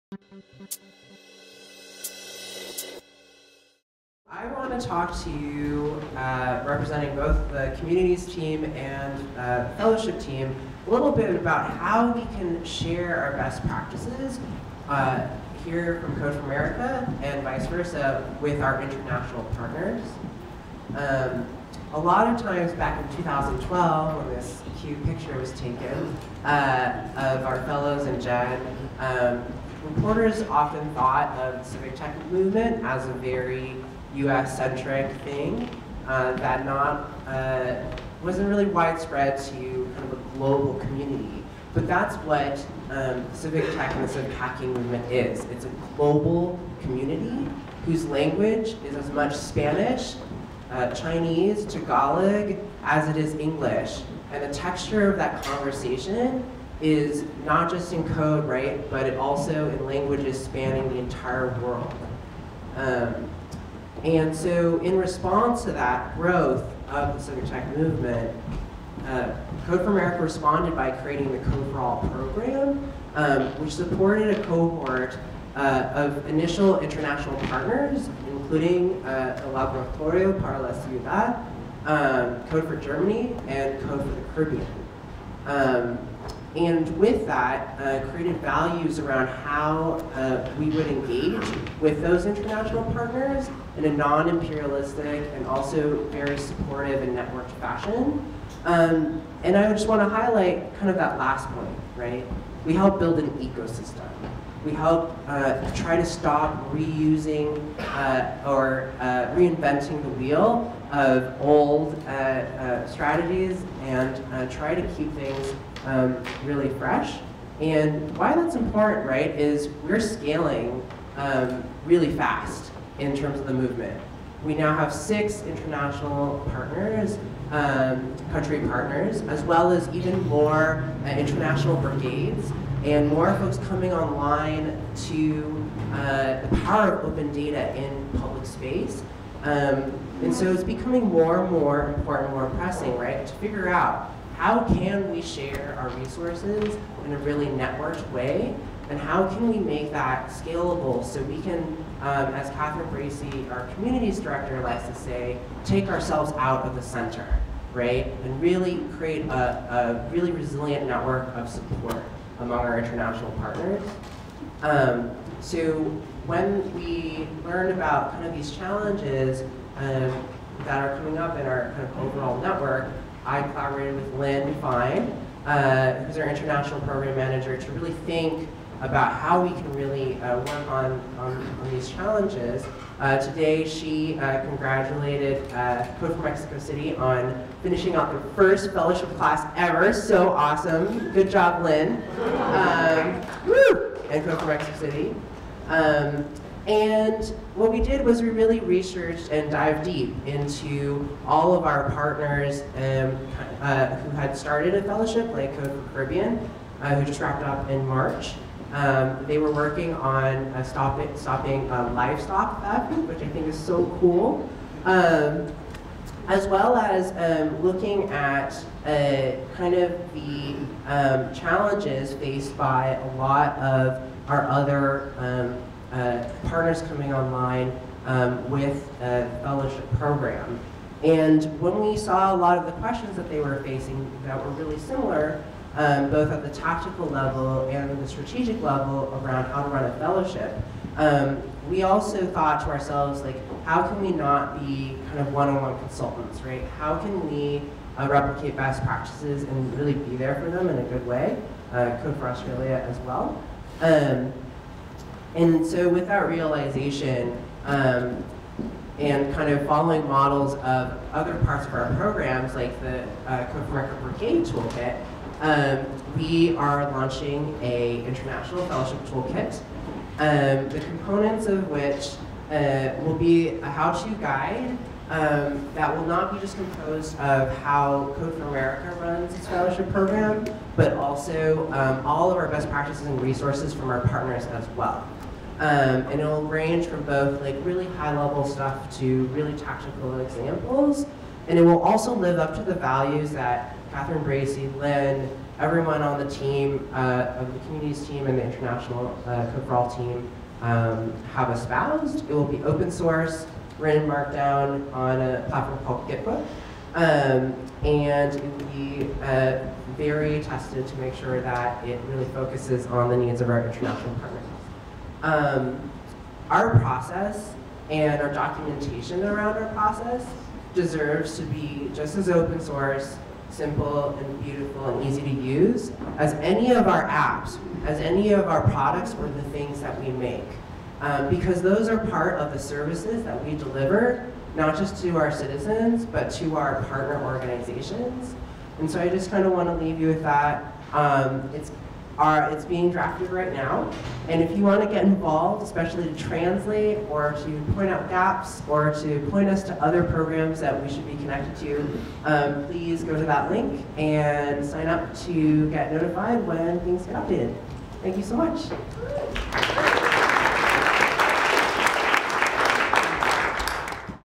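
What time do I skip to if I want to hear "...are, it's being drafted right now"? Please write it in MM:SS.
05:42.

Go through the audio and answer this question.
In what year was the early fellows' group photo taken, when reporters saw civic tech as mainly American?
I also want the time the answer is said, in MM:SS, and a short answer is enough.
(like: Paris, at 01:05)
2012, at 00:23.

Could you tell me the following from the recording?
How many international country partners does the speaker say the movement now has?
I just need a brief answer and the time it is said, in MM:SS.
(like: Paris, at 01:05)
6, at 02:04.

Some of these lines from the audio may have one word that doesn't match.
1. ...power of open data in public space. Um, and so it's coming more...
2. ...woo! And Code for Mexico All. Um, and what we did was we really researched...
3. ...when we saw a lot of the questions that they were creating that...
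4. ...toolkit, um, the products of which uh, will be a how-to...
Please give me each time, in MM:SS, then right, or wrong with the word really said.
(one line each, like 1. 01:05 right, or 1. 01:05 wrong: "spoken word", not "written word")
1. 02:16 wrong: "becoming", not "coming"
2. 03:13 wrong: "City", not "All"
3. 03:51 wrong: "facing", not "creating"
4. 04:29 wrong: "components", not "products".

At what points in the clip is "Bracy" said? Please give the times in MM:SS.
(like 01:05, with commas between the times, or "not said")
02:32, 04:54.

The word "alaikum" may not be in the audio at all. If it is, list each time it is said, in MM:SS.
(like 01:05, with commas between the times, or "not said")
not said.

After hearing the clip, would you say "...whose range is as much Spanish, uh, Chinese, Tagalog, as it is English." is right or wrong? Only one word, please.
wrong.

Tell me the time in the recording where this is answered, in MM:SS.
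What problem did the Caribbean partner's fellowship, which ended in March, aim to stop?
03:31.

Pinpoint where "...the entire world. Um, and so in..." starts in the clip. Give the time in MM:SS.
01:00.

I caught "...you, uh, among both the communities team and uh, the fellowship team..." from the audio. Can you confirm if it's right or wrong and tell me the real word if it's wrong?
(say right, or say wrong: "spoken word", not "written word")
wrong: "representing", not "among".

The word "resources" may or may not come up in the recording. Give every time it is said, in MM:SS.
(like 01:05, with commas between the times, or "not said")
02:25, 04:43.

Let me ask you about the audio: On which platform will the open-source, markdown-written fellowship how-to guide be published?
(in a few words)
Gitbook.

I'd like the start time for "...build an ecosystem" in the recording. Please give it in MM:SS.
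01:42.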